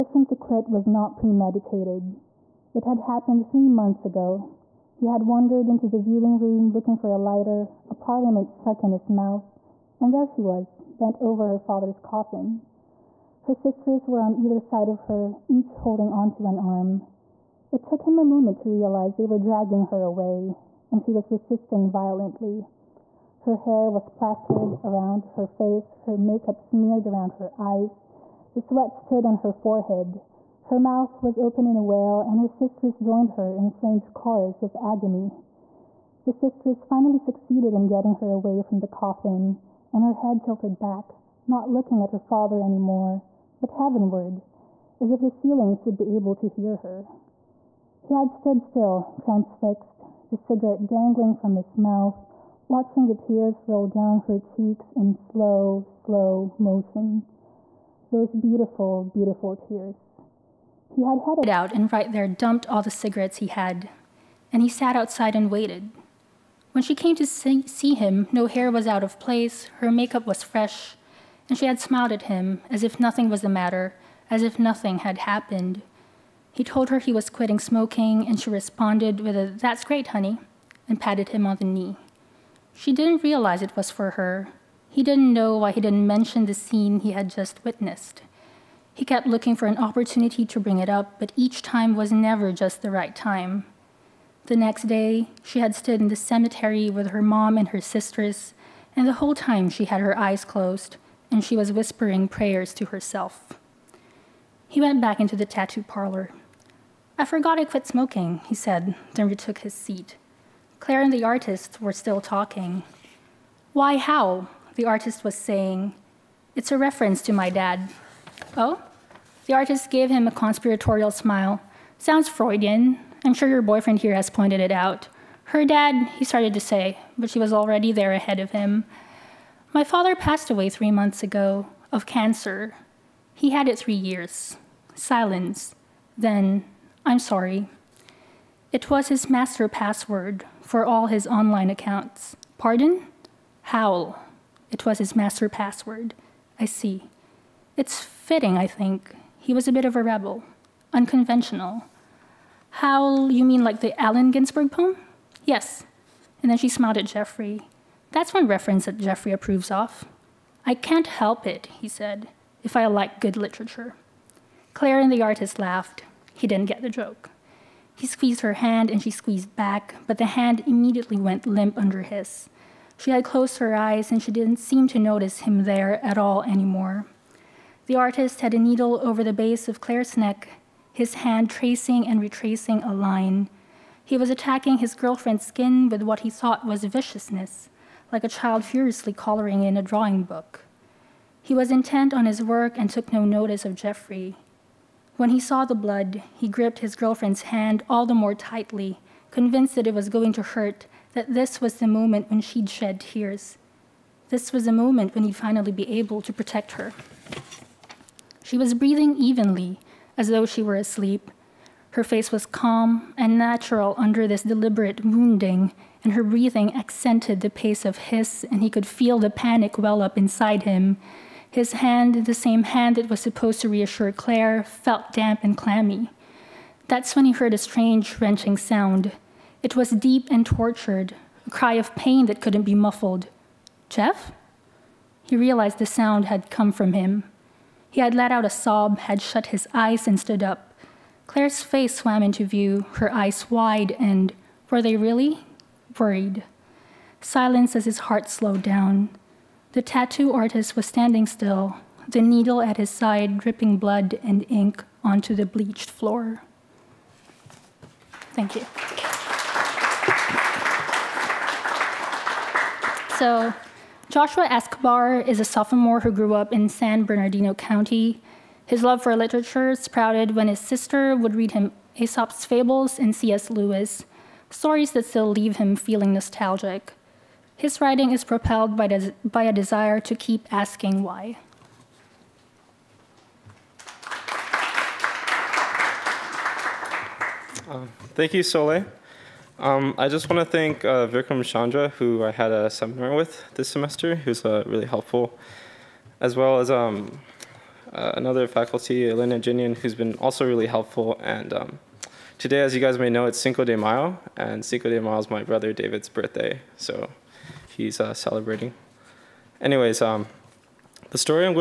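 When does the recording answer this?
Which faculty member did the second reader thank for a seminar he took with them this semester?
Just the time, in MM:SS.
04:51.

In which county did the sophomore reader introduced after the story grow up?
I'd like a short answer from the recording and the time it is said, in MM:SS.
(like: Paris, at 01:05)
San Bernardino County, at 04:26.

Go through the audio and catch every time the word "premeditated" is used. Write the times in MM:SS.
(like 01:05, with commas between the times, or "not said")
00:01.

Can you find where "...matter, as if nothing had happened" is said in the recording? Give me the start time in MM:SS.
01:13.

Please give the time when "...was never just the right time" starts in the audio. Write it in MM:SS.
01:31.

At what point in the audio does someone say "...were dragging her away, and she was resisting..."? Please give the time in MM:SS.
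00:19.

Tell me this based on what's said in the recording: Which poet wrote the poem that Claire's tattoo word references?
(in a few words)
Allen Ginsberg.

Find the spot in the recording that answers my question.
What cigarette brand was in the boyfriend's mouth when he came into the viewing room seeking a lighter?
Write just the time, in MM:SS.
00:07.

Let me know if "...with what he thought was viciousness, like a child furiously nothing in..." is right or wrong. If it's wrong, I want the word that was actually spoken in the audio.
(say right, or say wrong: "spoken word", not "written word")
wrong: "coloring", not "nothing".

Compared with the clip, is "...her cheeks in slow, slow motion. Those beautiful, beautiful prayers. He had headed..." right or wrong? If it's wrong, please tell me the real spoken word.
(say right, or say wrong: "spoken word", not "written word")
wrong: "tears", not "prayers".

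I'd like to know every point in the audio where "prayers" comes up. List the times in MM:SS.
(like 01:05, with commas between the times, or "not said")
01:42.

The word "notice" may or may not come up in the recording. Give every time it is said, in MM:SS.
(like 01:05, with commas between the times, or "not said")
02:54, 03:13.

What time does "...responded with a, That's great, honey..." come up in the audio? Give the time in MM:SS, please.
01:18.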